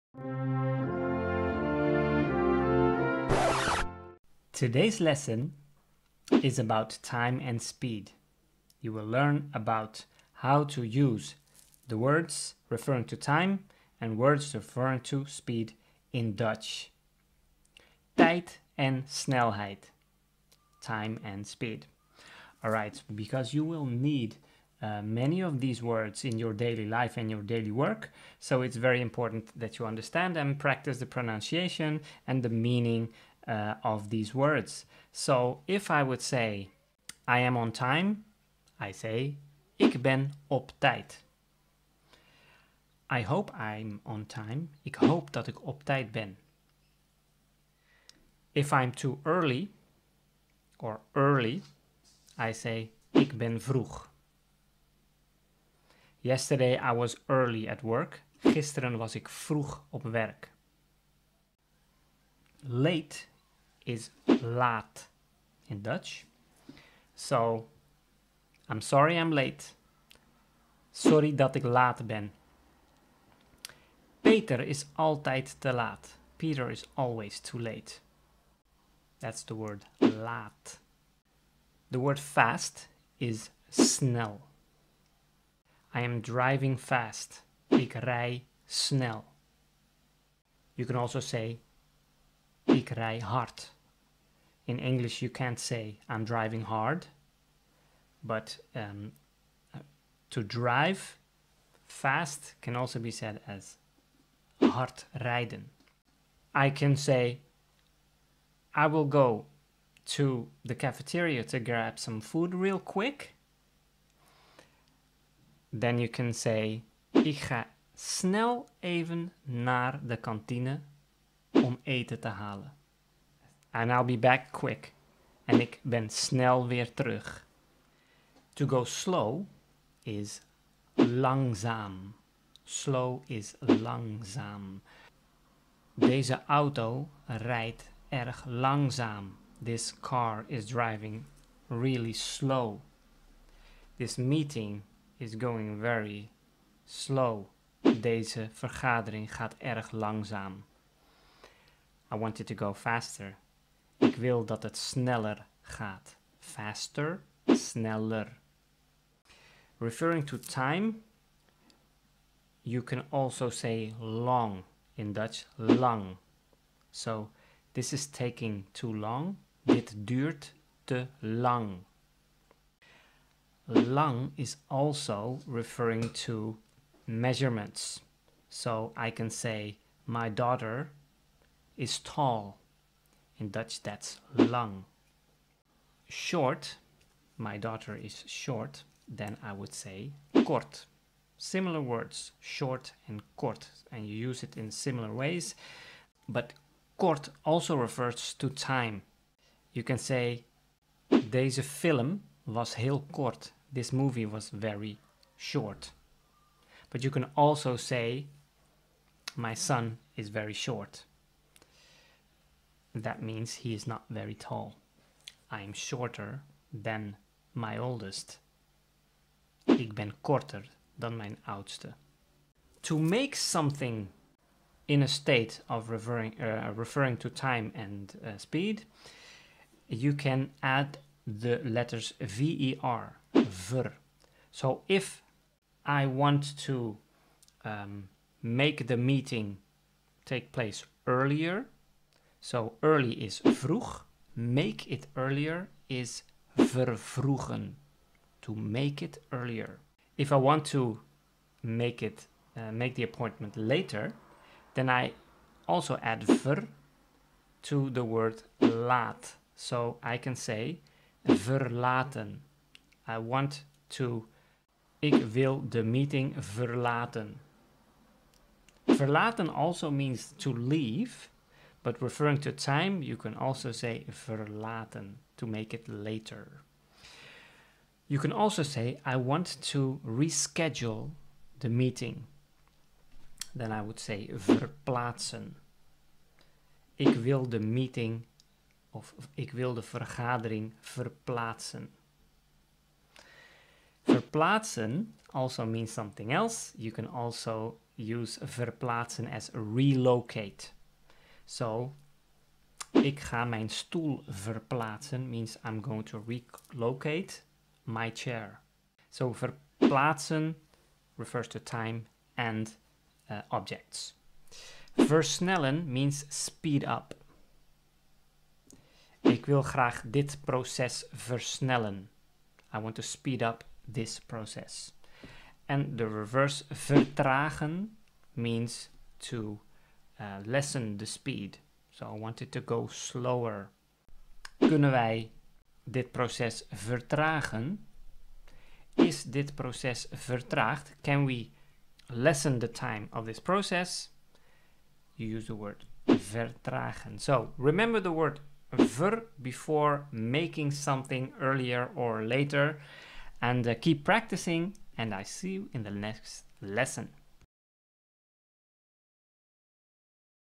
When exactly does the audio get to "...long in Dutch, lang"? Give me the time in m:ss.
2:43.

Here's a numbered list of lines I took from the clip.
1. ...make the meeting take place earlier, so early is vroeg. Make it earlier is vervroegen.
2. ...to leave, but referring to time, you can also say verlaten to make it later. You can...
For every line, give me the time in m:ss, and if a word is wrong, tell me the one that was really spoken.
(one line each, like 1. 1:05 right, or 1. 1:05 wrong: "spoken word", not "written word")
1. 3:58 right
2. 4:30 right.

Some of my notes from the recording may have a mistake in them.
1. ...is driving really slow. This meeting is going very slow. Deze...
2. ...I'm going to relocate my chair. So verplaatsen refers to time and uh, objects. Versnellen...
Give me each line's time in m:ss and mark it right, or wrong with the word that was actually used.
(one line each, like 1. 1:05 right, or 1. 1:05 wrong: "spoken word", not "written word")
1. 2:20 right
2. 5:05 right.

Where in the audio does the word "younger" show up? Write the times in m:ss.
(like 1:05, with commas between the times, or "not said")
not said.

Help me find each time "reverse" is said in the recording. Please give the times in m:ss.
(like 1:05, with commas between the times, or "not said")
5:26.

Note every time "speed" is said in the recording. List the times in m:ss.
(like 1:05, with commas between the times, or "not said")
0:07, 0:15, 0:21, 3:48, 5:16, 5:23, 5:31.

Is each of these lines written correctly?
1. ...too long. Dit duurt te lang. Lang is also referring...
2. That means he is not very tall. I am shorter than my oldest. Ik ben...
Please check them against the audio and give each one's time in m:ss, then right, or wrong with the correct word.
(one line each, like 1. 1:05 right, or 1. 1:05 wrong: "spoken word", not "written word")
1. 2:48 right
2. 3:32 right.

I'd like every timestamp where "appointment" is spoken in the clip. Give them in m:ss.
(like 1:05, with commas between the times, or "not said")
4:13.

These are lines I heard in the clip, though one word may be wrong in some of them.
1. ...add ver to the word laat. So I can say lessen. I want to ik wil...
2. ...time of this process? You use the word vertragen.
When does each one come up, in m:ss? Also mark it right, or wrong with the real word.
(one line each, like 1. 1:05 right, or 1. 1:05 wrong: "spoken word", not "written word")
1. 4:16 wrong: "verlaten", not "lessen"
2. 5:42 right.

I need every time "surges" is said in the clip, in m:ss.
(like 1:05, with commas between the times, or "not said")
not said.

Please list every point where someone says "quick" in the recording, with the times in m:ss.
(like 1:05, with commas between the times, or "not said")
1:52, 2:04.